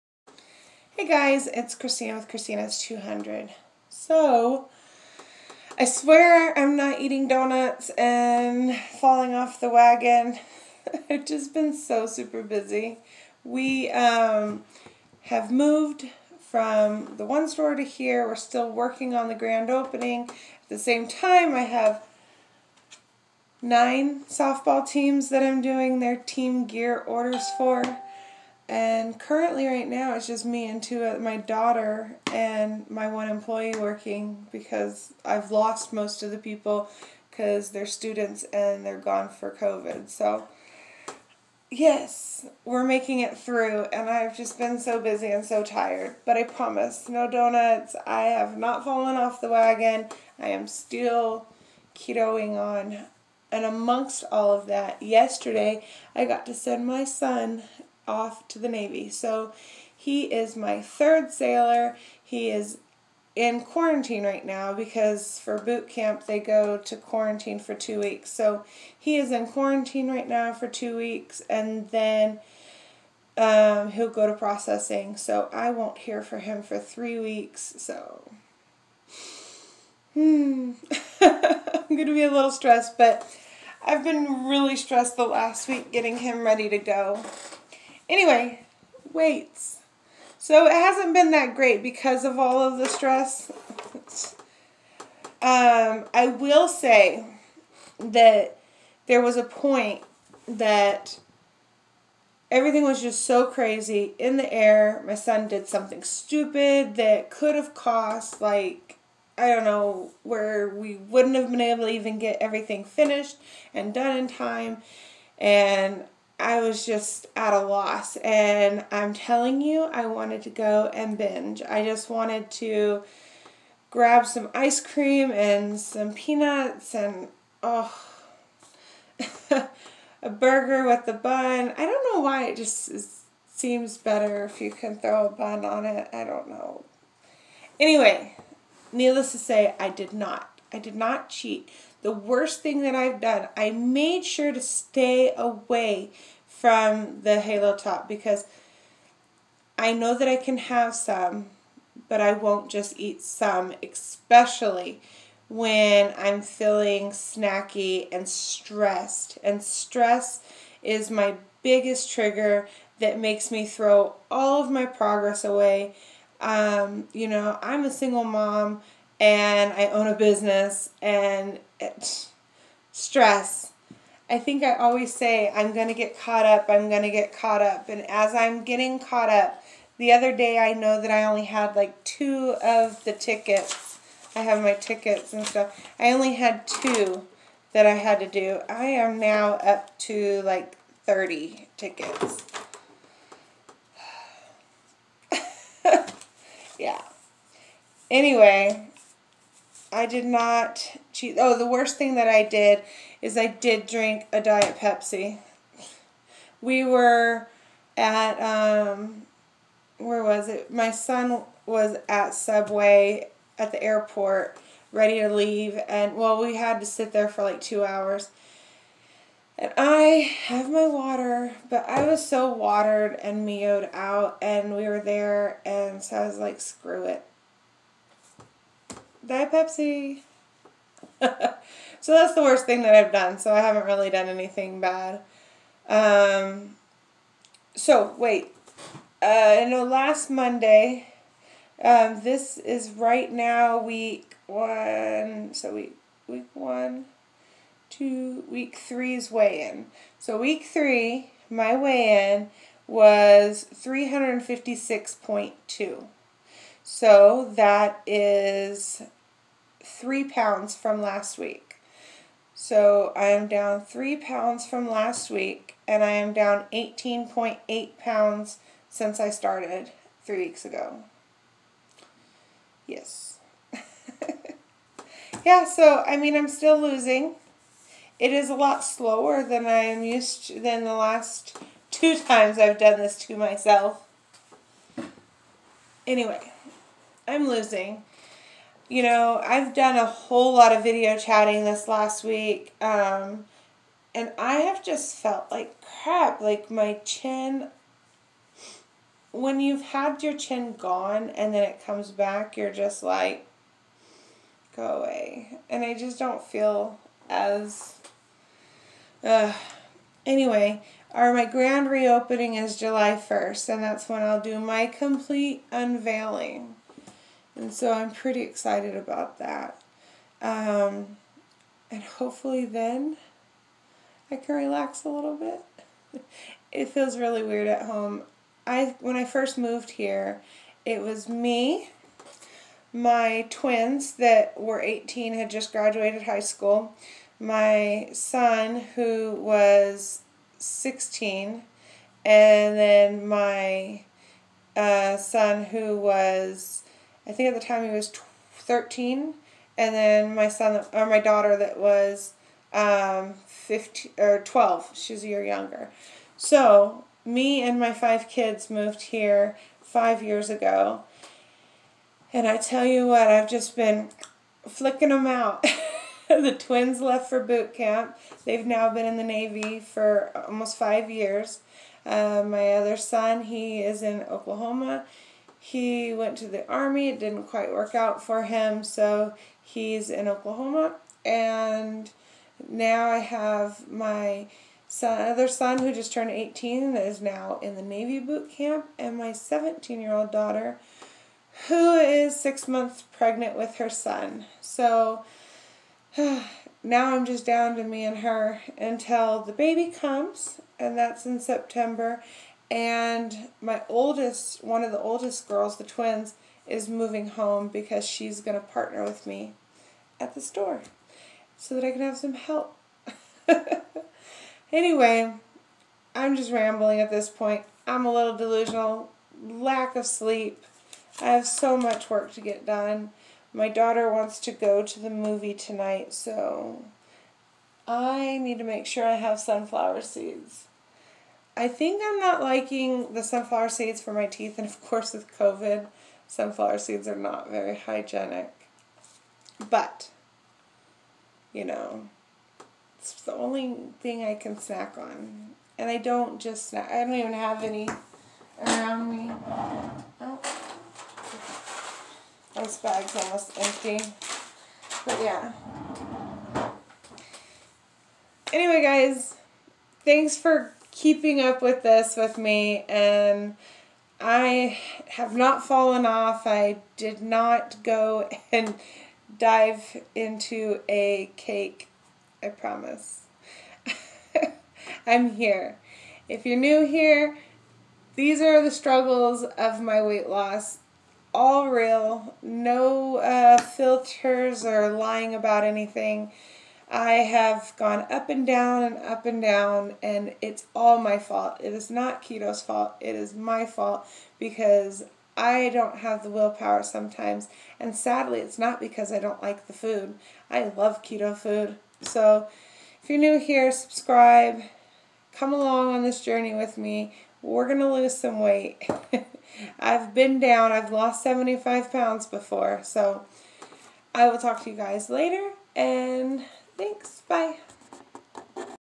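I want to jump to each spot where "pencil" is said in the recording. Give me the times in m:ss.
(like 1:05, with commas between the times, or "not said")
not said.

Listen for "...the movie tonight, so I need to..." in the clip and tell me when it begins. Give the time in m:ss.
7:04.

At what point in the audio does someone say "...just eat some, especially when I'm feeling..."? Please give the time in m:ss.
2:32.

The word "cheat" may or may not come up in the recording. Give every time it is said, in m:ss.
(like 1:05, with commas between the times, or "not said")
2:21, 3:21.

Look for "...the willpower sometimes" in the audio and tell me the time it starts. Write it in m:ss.
8:16.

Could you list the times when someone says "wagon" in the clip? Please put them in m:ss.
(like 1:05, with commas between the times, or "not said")
0:09, 0:49.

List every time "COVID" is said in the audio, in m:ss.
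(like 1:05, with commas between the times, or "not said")
0:39, 7:15.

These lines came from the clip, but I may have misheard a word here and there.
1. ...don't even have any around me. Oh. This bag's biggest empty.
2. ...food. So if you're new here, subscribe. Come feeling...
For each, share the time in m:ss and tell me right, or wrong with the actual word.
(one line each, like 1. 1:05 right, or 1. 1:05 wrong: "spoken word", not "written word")
1. 7:27 wrong: "almost", not "biggest"
2. 8:21 wrong: "along", not "feeling".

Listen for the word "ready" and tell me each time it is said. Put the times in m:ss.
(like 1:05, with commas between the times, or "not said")
1:26, 3:34.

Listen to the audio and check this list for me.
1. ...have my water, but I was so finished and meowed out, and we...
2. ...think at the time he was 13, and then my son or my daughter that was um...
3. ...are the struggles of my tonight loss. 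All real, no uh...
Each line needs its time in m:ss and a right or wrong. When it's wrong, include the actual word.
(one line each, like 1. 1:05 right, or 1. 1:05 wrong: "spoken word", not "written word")
1. 3:40 wrong: "watered", not "finished"
2. 5:47 right
3. 7:58 wrong: "weight", not "tonight".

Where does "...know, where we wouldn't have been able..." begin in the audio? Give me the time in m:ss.
1:49.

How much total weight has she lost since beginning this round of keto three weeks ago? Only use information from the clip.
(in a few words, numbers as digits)
18.8 pounds.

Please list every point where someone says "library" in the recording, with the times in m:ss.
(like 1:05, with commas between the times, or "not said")
not said.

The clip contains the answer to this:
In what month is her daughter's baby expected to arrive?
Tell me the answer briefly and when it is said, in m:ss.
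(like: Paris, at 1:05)
September, at 6:41.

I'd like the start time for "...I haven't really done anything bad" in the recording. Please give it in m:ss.
3:53.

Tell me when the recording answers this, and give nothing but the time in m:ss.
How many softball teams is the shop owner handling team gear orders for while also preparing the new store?
0:23.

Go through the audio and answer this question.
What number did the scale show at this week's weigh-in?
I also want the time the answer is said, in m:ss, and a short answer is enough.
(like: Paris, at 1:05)
356.2, at 4:13.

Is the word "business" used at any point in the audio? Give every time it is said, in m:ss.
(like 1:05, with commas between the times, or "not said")
2:50.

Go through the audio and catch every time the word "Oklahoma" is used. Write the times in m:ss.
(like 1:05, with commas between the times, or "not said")
6:14, 6:20.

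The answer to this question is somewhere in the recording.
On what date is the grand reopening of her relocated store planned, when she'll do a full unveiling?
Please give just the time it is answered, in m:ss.
5:12.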